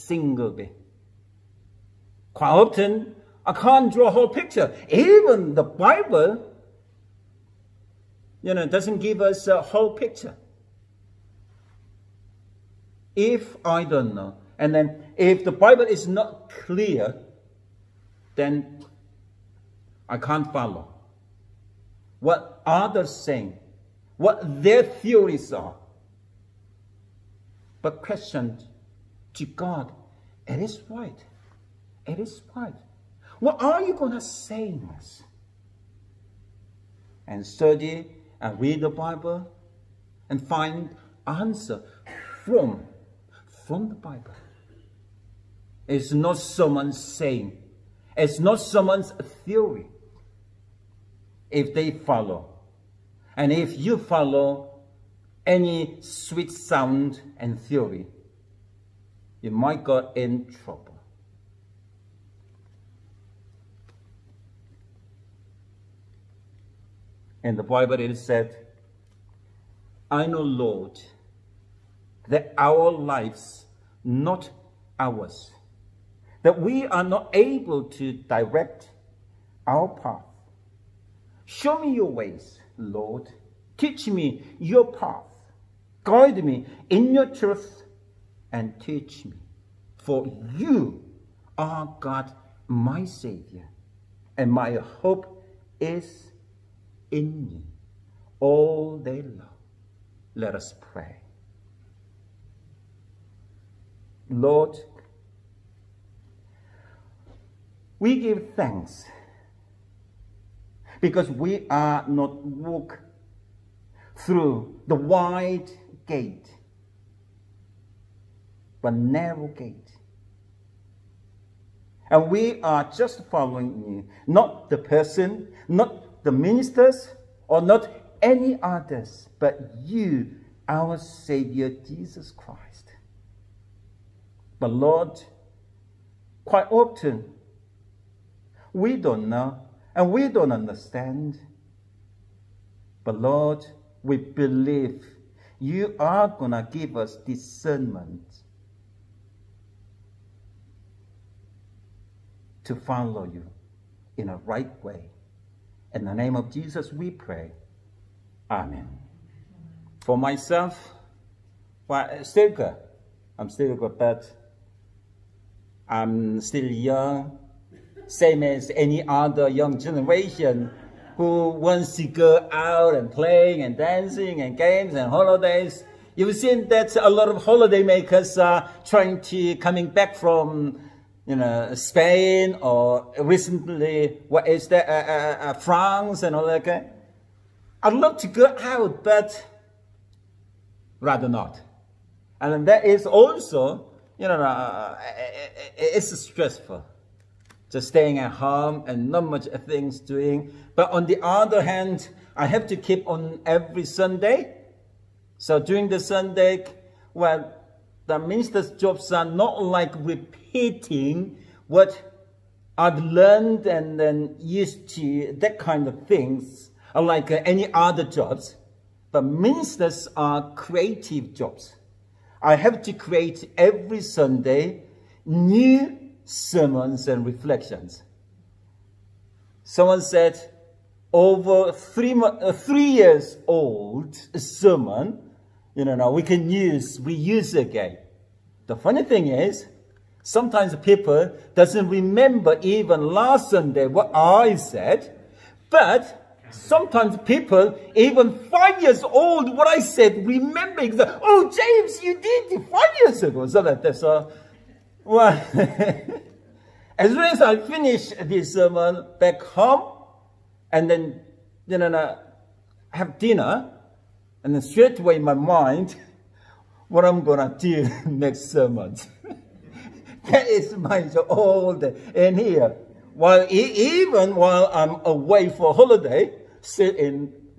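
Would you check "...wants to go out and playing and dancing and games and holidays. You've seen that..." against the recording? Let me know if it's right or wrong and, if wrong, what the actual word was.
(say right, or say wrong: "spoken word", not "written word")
right.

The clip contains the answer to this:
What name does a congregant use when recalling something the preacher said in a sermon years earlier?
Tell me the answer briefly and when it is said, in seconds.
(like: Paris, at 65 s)
James, at 251 s.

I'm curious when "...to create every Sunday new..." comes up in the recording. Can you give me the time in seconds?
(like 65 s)
222 s.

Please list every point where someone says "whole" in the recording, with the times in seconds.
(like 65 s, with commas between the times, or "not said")
4 s, 9 s.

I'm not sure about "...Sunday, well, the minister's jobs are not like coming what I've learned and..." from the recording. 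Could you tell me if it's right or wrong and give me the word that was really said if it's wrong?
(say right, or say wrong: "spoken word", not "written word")
wrong: "repeating", not "coming".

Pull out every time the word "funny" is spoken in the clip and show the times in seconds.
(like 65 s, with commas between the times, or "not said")
238 s.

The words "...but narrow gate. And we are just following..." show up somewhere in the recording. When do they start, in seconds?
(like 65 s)
118 s.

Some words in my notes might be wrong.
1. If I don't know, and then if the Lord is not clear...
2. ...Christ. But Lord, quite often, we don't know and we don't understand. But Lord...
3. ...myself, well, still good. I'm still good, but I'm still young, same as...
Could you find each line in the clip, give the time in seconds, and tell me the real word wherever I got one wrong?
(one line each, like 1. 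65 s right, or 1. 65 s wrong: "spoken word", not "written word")
1. 13 s wrong: "Bible", not "Lord"
2. 132 s right
3. 160 s right.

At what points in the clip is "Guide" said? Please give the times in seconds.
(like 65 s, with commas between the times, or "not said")
86 s.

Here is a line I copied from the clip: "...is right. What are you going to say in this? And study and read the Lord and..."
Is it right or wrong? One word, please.
wrong.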